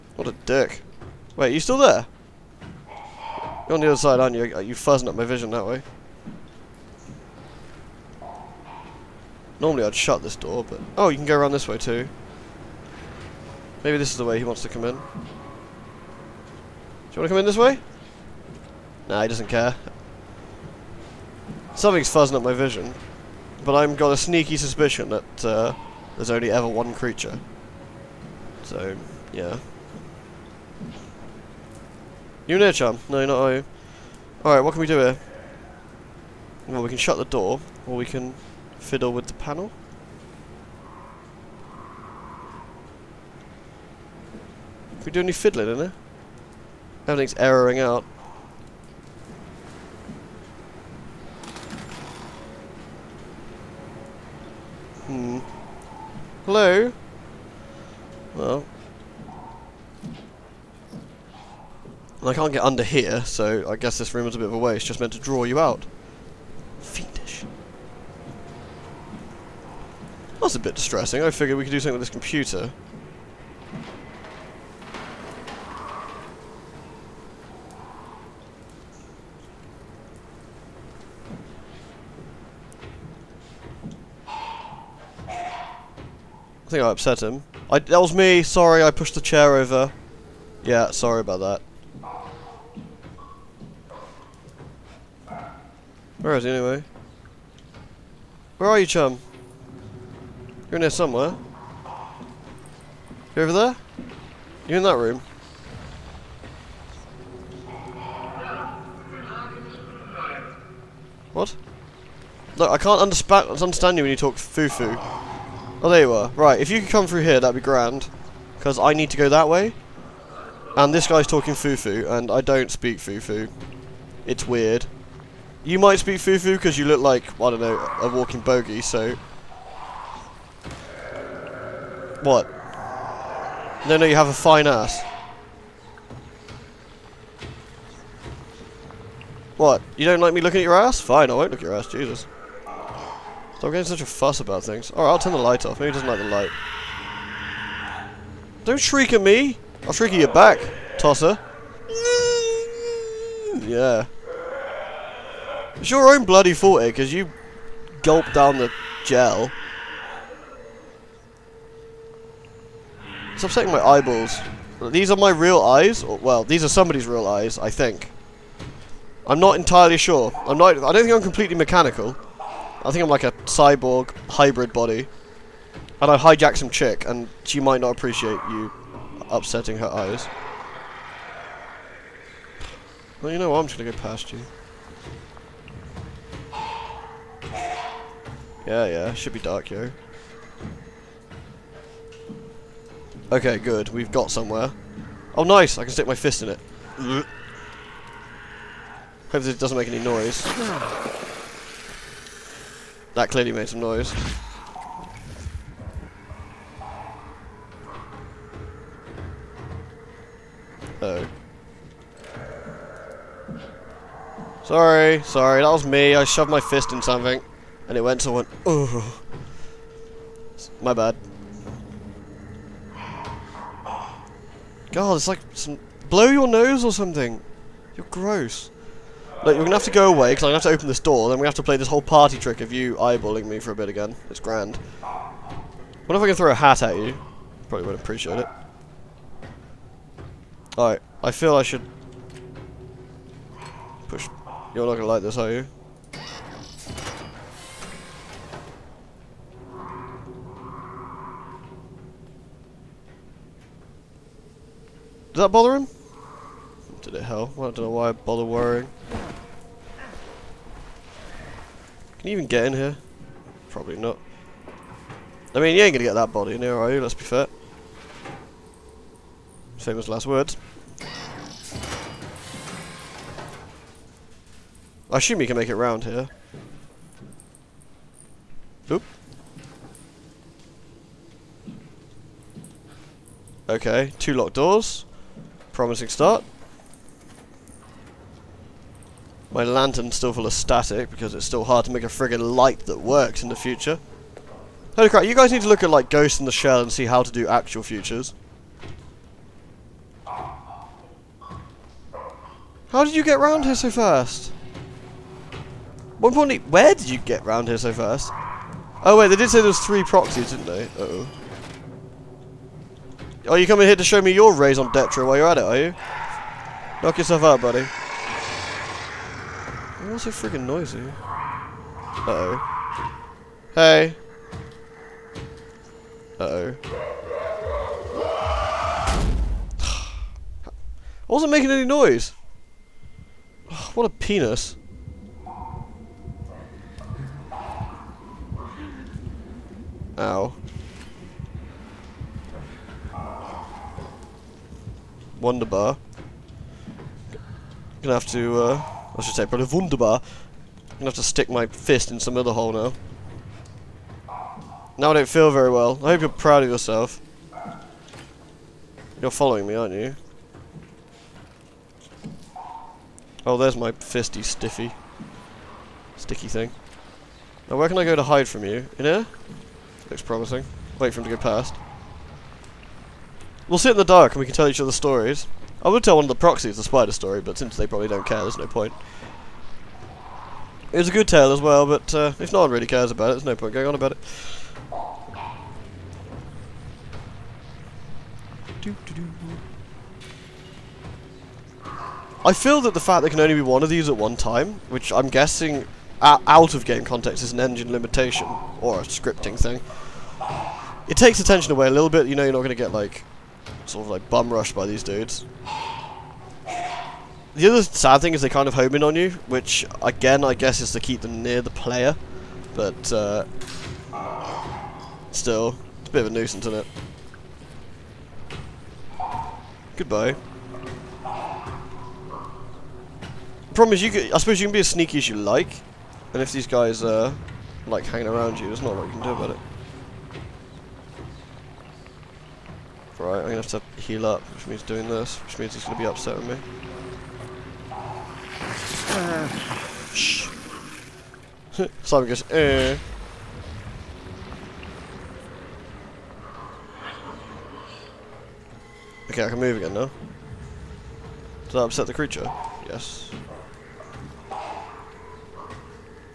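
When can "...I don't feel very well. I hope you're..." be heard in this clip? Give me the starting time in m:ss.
5:55.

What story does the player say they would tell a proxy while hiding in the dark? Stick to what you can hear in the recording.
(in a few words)
the spider story.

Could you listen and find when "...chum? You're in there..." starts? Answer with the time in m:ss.
1:38.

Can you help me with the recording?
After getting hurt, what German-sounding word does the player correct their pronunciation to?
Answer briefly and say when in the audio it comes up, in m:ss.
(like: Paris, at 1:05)
Wunderbar, at 5:49.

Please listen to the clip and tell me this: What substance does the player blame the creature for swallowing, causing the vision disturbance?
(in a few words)
the gel.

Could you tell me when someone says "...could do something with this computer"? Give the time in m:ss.
1:11.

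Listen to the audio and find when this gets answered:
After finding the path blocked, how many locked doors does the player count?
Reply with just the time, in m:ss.
4:44.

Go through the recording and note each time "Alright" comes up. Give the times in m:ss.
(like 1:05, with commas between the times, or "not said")
0:34, 2:24, 4:00.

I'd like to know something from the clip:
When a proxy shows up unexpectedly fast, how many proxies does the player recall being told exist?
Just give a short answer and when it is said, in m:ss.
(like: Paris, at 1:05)
3, at 5:09.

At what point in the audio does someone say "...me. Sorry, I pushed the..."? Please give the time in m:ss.
1:28.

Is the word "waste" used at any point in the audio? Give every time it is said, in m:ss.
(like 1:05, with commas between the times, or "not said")
1:04.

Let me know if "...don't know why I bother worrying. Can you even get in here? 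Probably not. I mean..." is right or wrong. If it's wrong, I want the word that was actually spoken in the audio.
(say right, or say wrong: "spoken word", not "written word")
right.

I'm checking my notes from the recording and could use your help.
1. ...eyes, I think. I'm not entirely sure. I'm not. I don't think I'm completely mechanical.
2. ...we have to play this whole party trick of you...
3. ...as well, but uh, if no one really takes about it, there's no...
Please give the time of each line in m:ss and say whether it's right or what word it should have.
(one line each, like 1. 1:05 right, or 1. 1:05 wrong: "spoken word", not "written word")
1. 2:47 right
2. 3:51 right
3. 6:21 wrong: "cares", not "takes".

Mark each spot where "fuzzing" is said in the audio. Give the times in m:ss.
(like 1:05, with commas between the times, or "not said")
0:04, 0:22.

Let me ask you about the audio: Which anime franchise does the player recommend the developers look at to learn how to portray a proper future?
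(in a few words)
Ghost in the Shell.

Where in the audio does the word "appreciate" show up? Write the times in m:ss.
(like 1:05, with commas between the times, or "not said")
2:57, 3:57.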